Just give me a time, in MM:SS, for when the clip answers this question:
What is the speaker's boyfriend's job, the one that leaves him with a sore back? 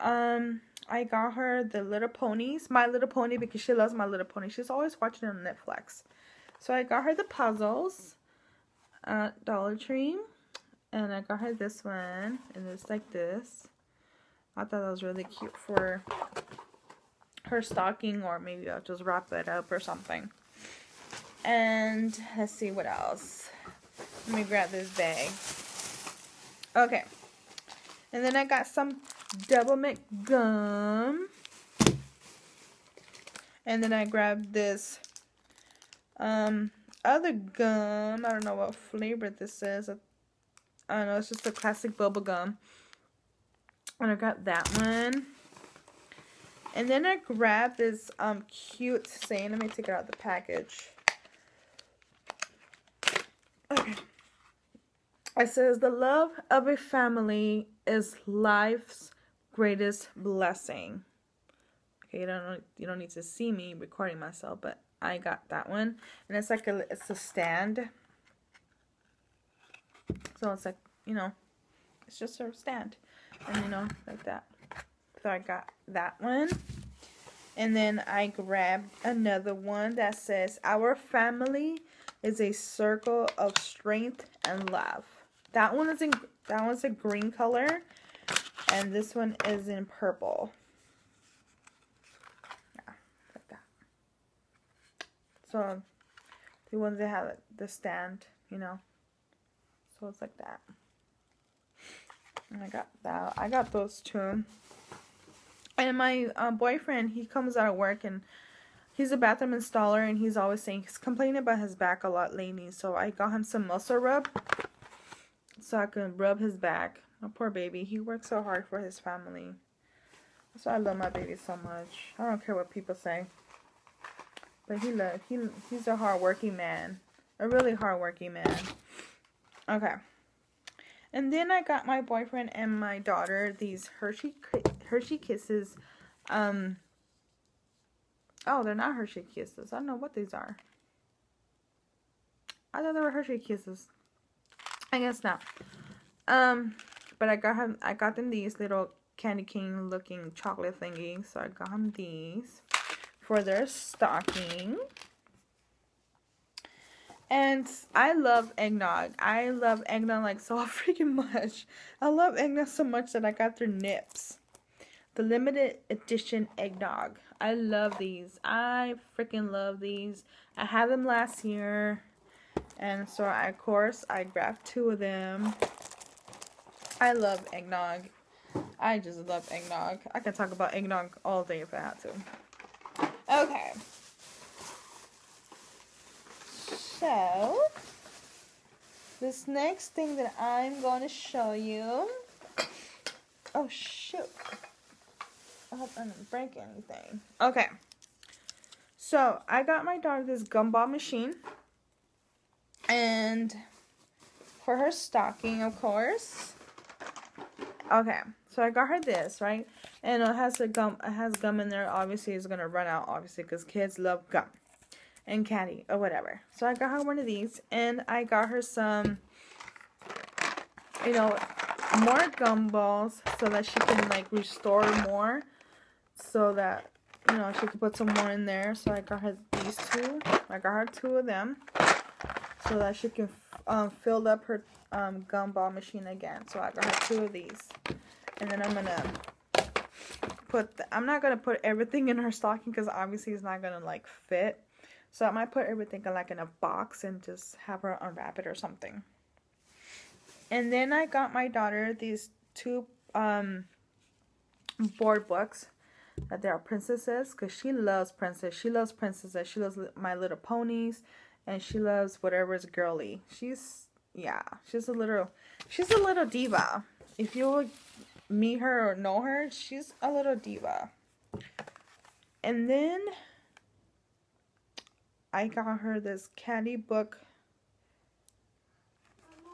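01:49.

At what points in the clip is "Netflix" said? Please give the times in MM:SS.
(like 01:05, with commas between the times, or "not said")
00:05.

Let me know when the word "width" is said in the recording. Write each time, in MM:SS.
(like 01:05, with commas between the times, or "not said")
not said.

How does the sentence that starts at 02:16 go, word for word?
Um, oh, they're not Hershey Kisses.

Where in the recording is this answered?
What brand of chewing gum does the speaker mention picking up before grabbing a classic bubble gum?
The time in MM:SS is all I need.
00:29.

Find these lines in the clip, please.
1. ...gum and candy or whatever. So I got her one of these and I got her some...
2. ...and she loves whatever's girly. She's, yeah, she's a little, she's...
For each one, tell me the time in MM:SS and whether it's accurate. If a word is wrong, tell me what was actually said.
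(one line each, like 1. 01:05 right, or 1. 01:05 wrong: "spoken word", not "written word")
1. 03:34 right
2. 04:21 right.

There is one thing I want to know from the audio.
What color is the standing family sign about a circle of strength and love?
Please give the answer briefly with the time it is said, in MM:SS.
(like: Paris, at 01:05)
Green, at 01:26.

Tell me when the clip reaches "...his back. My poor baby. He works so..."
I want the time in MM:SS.
01:56.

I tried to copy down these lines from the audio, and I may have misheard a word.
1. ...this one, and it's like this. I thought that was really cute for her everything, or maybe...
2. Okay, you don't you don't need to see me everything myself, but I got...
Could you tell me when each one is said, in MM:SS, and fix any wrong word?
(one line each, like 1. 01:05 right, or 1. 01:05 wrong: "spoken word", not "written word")
1. 00:11 wrong: "stocking", not "everything"
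2. 01:02 wrong: "recording", not "everything".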